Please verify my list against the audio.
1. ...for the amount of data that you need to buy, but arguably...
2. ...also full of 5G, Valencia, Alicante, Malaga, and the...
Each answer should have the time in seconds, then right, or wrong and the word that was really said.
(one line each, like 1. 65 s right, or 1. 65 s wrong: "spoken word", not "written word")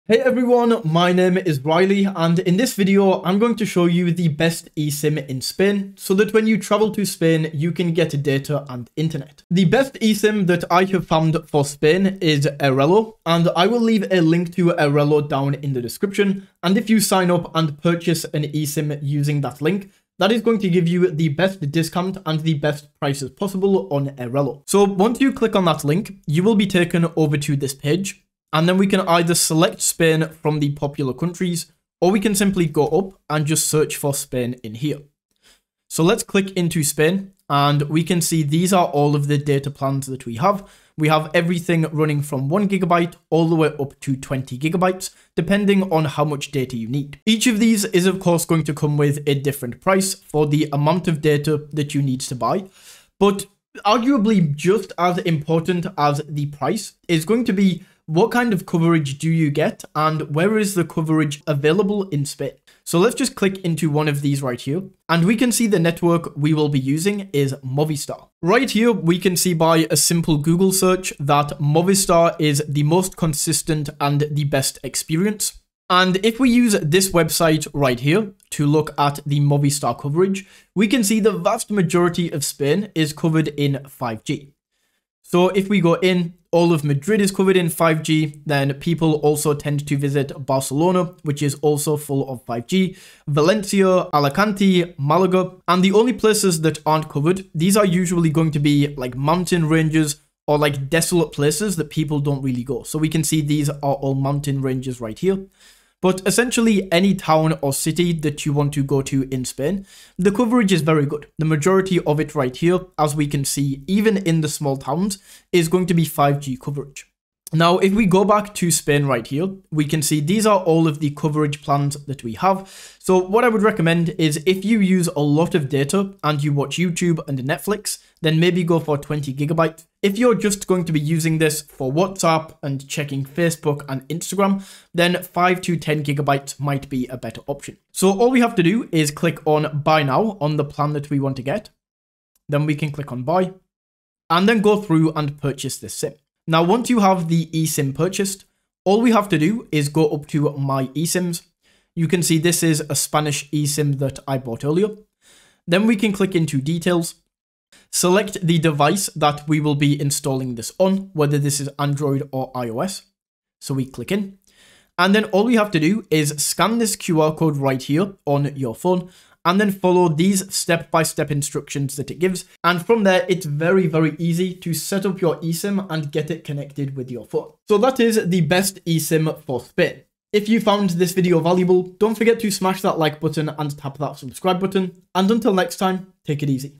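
1. 50 s right
2. 91 s right.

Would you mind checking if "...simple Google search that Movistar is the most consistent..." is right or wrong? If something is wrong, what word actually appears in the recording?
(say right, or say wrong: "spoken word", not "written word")
right.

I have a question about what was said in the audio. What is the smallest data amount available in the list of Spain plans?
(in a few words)
1 gigabyte.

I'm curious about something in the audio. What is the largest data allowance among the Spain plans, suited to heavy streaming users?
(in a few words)
20 gigabytes.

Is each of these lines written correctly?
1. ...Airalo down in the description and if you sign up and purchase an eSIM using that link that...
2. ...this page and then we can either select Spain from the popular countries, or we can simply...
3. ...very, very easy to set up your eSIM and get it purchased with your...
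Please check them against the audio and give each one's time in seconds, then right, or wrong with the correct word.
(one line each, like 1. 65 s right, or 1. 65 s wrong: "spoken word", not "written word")
1. 14 s right
2. 27 s right
3. 173 s wrong: "connected", not "purchased".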